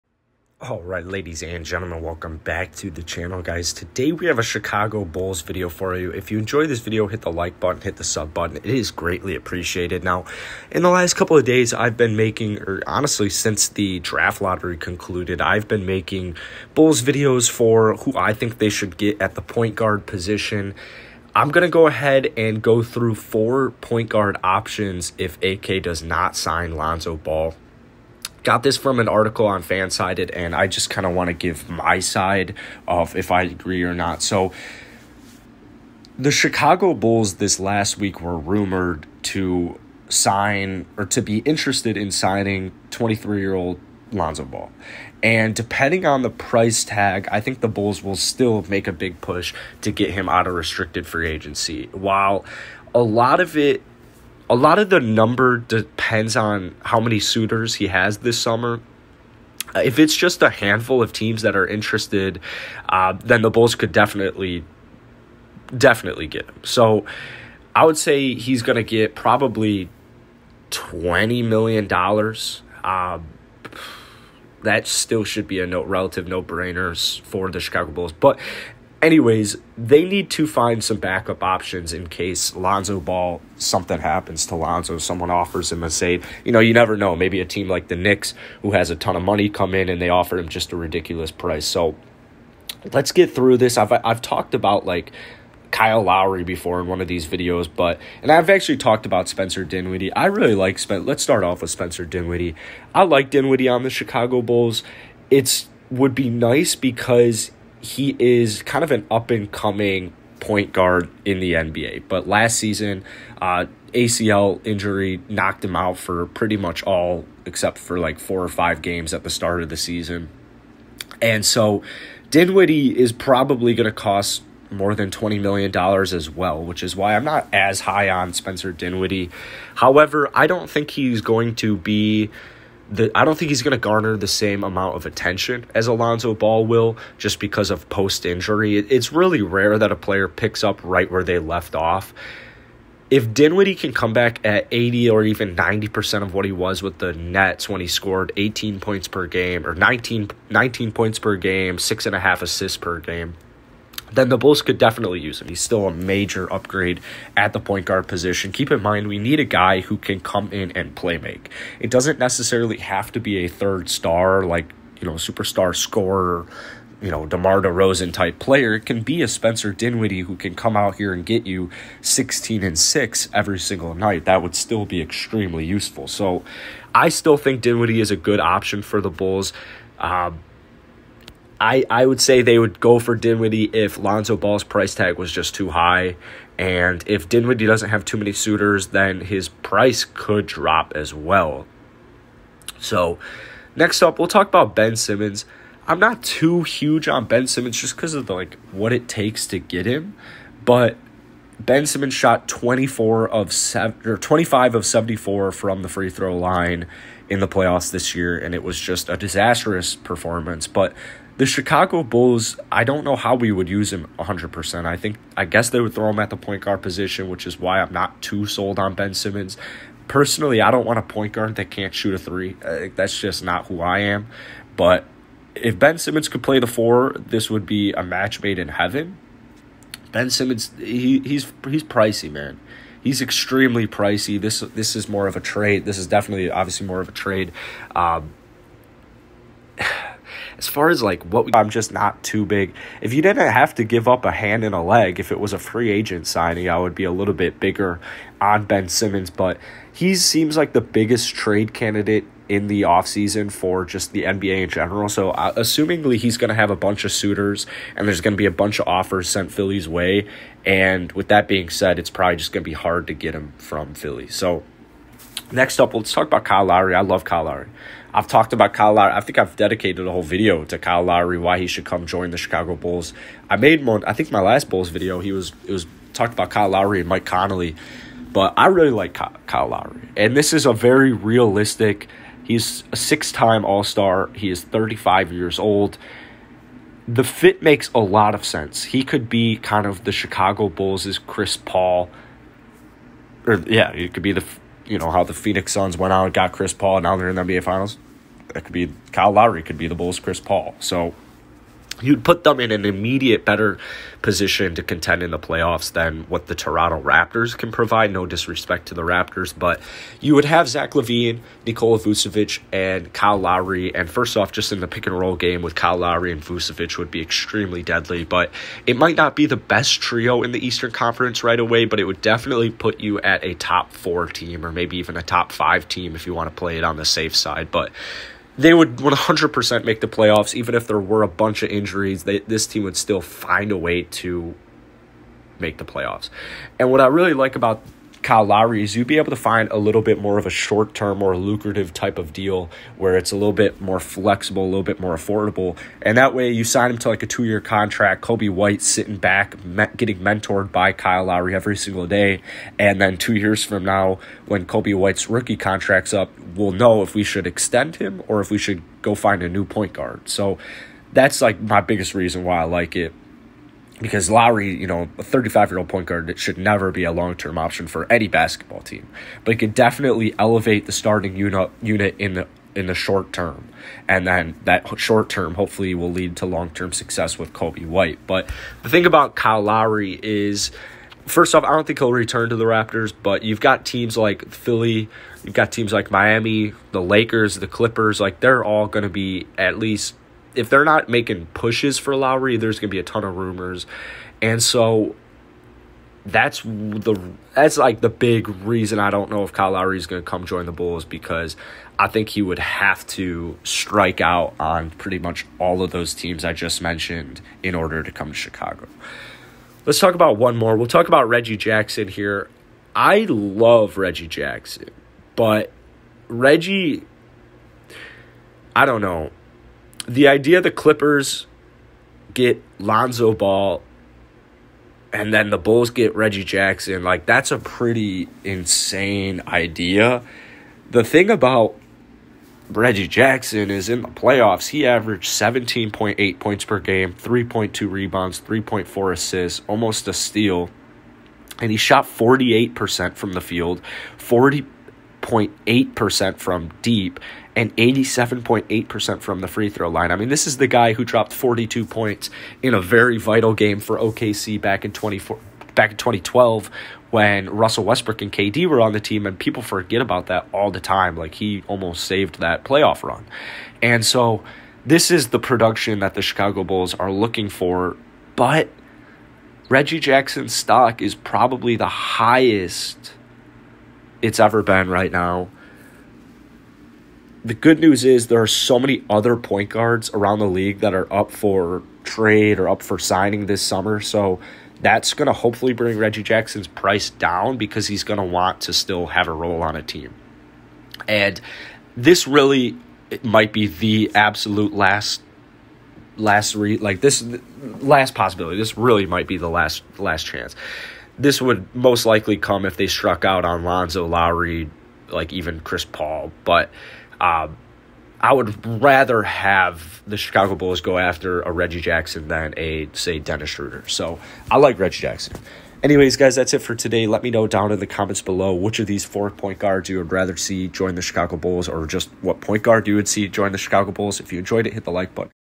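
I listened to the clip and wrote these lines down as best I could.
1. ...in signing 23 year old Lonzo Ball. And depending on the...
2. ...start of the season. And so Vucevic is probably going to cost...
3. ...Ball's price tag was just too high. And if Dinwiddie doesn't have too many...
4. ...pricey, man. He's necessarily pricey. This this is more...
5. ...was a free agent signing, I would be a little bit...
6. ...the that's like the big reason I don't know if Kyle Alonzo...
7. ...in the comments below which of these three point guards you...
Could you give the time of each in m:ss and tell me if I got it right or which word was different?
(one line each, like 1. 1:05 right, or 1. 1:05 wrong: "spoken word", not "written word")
1. 0:41 right
2. 1:59 wrong: "Dinwiddie", not "Vucevic"
3. 3:04 right
4. 3:51 wrong: "extremely", not "necessarily"
5. 4:05 right
6. 6:36 wrong: "Lowry", not "Alonzo"
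7. 8:37 wrong: "four", not "three".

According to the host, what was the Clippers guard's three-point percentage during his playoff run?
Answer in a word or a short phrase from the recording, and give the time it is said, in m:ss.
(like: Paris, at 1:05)
40.8%, at 7:24.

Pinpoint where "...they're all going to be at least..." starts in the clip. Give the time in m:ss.
6:28.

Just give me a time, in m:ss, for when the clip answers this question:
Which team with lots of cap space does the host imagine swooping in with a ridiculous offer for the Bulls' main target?
1:27.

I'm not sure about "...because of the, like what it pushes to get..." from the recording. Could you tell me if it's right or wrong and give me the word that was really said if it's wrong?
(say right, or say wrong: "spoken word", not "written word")
wrong: "takes", not "pushes".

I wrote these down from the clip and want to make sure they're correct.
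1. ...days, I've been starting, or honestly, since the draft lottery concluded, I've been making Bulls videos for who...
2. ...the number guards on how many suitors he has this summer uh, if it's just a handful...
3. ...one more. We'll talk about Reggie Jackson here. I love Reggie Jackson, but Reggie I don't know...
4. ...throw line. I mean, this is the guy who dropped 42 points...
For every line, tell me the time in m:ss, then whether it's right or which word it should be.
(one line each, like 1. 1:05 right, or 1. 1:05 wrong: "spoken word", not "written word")
1. 0:11 wrong: "making", not "starting"
2. 0:54 wrong: "depends", not "guards"
3. 6:50 right
4. 7:29 right.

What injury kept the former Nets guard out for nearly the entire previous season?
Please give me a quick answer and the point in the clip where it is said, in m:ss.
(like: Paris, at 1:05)
ACL injury, at 1:53.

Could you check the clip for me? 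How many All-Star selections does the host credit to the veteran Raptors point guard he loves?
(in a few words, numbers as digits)
6.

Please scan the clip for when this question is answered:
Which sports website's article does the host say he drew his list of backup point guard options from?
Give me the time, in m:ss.
0:29.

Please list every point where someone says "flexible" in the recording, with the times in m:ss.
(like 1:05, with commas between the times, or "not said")
5:43.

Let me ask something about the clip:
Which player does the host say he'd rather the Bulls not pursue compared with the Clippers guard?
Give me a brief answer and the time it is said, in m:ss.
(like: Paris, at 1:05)
Dennis Schroeder, at 8:33.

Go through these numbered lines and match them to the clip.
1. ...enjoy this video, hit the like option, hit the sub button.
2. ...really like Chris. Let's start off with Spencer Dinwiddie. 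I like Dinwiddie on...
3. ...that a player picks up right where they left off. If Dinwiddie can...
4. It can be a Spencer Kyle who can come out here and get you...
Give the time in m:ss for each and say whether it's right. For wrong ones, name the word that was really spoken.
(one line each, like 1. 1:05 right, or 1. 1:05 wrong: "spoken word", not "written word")
1. 0:06 wrong: "button", not "option"
2. 1:40 wrong: "Spencer", not "Chris"
3. 2:19 right
4. 2:48 wrong: "Dinwiddie", not "Kyle".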